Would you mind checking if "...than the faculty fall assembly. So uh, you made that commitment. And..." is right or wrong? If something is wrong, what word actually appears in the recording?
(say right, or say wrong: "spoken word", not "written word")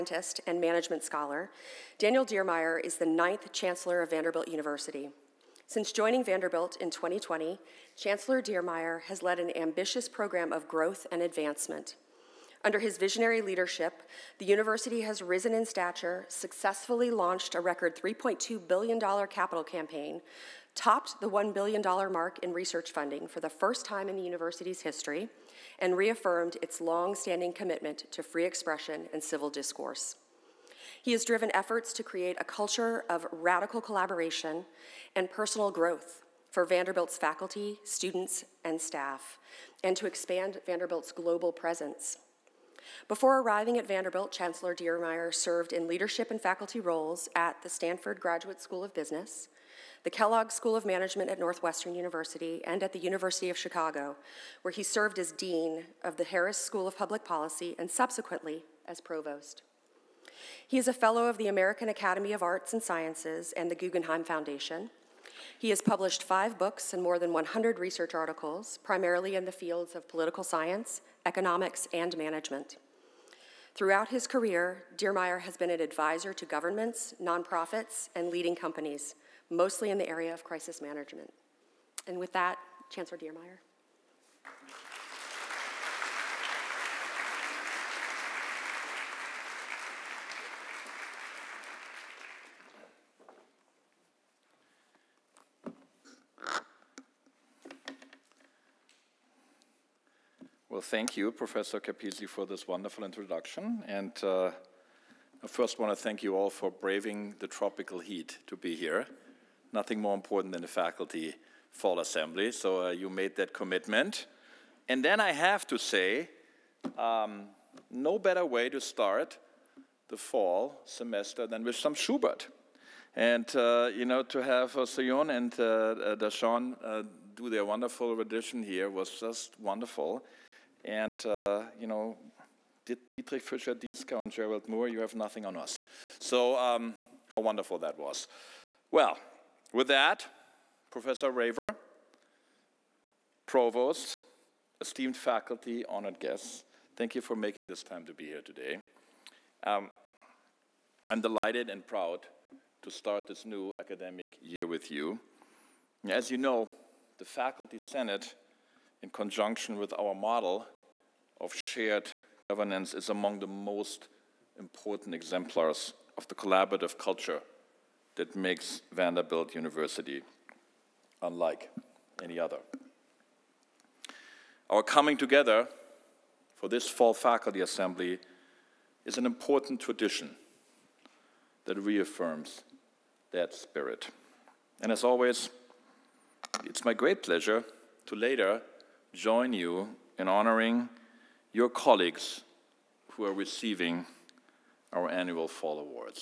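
right.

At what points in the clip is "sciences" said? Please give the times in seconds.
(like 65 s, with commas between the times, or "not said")
62 s, 70 s.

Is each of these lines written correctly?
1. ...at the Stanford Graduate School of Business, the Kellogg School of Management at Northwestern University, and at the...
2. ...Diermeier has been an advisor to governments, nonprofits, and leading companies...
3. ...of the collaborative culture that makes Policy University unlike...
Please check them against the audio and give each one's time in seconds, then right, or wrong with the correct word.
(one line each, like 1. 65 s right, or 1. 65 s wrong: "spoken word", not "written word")
1. 47 s right
2. 74 s right
3. 166 s wrong: "Vanderbilt", not "Policy".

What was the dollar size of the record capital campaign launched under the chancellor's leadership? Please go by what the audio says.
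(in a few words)
$3.2 billion.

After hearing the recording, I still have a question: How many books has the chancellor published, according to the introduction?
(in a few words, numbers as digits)
5.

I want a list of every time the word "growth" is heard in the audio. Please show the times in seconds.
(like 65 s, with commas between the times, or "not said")
10 s, 35 s.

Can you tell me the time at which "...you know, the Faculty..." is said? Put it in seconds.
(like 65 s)
156 s.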